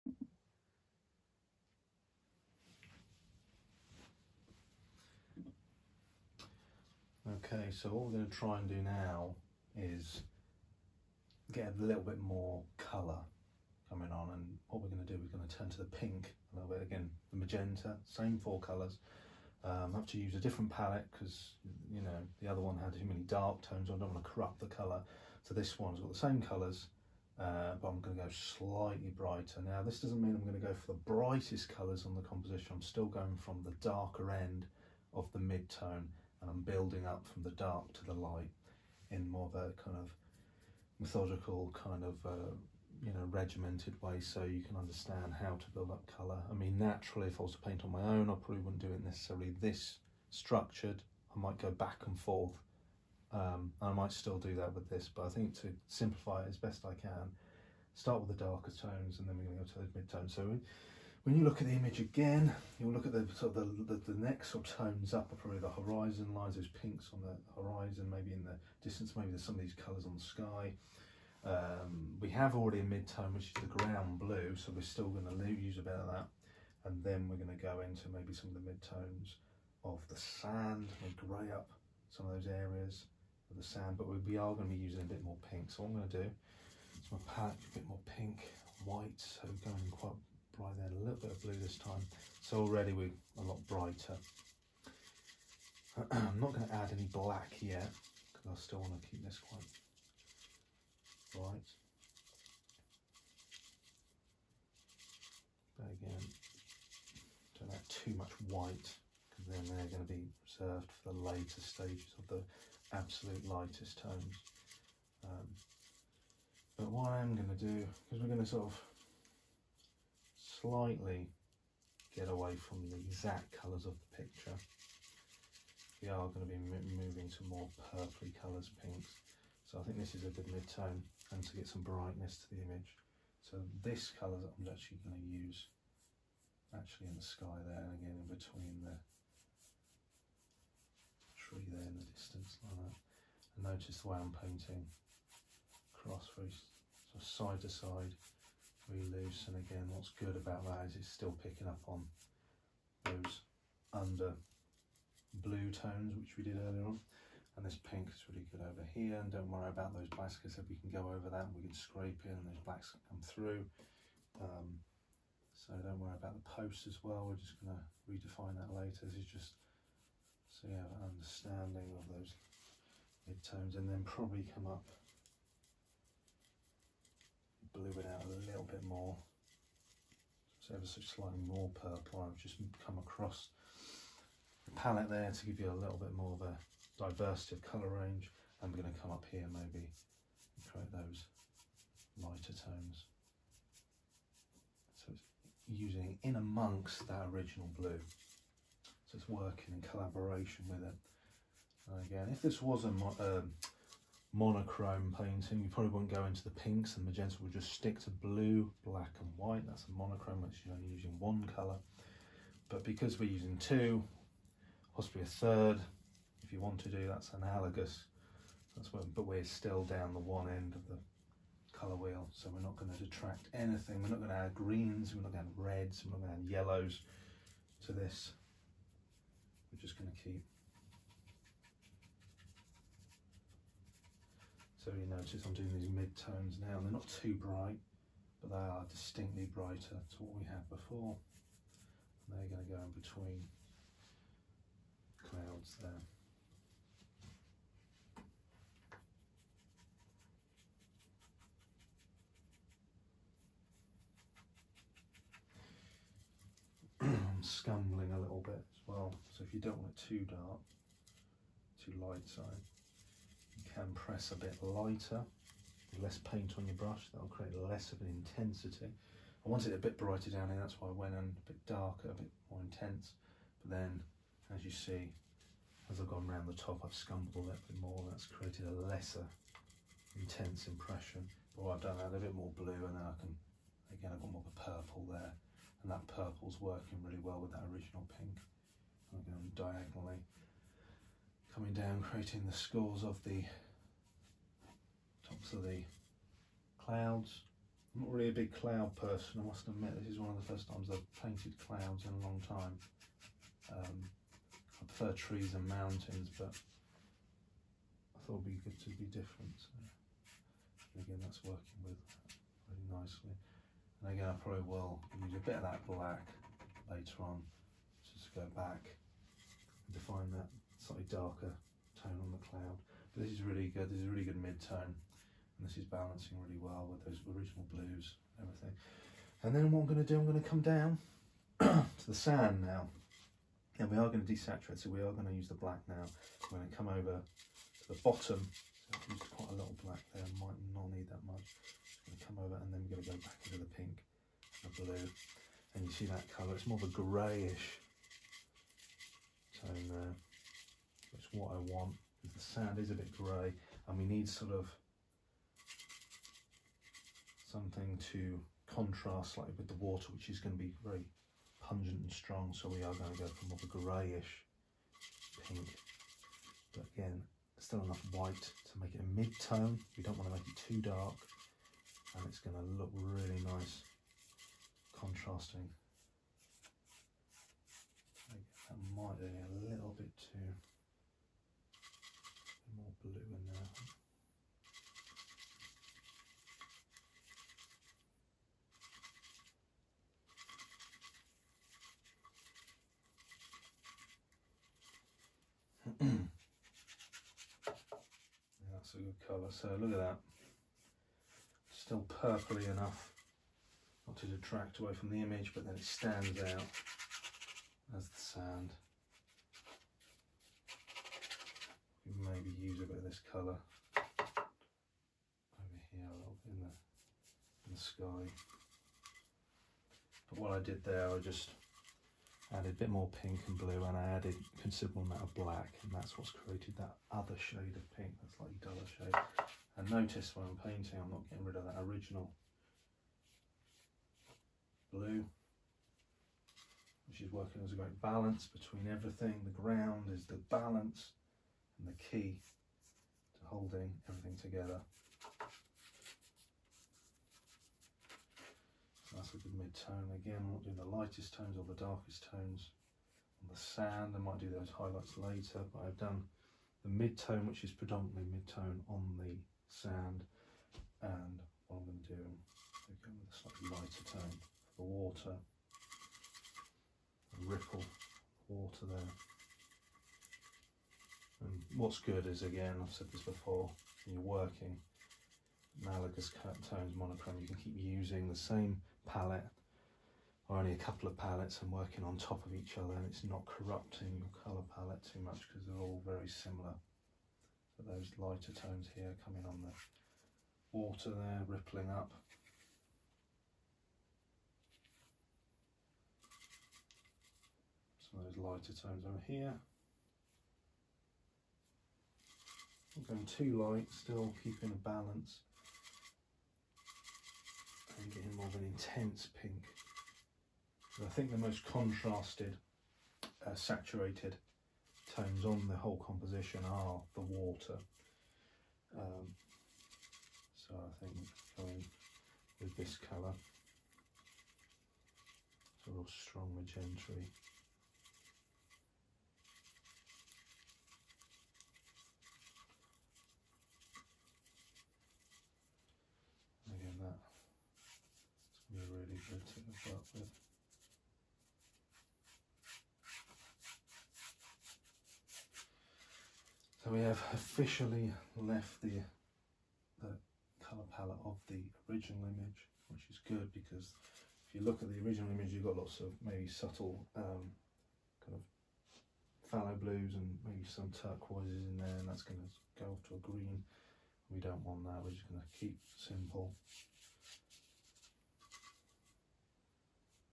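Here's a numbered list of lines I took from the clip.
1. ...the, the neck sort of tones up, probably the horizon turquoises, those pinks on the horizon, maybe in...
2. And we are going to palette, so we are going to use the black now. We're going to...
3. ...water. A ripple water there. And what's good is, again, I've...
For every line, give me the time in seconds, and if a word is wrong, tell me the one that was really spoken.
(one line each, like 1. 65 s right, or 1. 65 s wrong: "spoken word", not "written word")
1. 63 s wrong: "lines", not "turquoises"
2. 333 s wrong: "desaturate", not "palette"
3. 464 s right.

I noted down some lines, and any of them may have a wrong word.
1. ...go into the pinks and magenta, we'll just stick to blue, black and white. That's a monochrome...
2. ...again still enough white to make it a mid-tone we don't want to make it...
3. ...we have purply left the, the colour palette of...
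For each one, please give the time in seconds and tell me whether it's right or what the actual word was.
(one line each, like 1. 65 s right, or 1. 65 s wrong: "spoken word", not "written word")
1. 206 s right
2. 366 s right
3. 546 s wrong: "officially", not "purply".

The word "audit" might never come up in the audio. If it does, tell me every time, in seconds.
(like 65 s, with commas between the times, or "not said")
not said.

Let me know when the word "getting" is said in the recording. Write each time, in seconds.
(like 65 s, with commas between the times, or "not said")
431 s, 508 s.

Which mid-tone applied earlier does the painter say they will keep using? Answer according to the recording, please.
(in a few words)
The ground blue.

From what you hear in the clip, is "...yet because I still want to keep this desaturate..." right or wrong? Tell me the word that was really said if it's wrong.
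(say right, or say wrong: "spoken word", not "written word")
wrong: "quite", not "desaturate".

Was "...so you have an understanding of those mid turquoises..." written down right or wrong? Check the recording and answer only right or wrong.
wrong.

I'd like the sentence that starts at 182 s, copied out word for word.
I've just come across the palette there to give you a little bit more of a diversity of colour range.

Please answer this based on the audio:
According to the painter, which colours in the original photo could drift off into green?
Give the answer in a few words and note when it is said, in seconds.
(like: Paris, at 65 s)
Turquoises, at 560 s.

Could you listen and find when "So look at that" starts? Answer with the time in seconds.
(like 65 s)
399 s.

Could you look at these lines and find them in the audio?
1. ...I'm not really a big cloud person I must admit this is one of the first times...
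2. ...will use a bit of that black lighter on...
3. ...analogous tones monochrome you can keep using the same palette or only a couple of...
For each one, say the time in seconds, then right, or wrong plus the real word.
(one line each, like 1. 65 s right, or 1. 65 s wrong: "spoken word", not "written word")
1. 297 s right
2. 314 s wrong: "later", not "lighter"
3. 475 s right.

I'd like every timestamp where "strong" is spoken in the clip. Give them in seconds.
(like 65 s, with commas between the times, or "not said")
362 s, 526 s.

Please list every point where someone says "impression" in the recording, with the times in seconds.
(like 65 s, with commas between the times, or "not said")
280 s.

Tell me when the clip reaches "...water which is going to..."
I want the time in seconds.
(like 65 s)
359 s.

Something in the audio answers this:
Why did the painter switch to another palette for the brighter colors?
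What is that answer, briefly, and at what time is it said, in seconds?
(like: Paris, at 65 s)
Too many dark tones, at 22 s.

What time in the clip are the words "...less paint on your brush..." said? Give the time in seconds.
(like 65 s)
266 s.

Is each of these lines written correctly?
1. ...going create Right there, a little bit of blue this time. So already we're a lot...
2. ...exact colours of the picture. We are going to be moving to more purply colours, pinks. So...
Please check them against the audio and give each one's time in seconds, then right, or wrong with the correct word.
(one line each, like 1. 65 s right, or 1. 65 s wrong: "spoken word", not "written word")
1. 89 s wrong: "quite", not "create"
2. 122 s right.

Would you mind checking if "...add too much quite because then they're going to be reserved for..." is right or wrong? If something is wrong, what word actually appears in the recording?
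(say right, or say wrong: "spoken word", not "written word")
wrong: "white", not "quite".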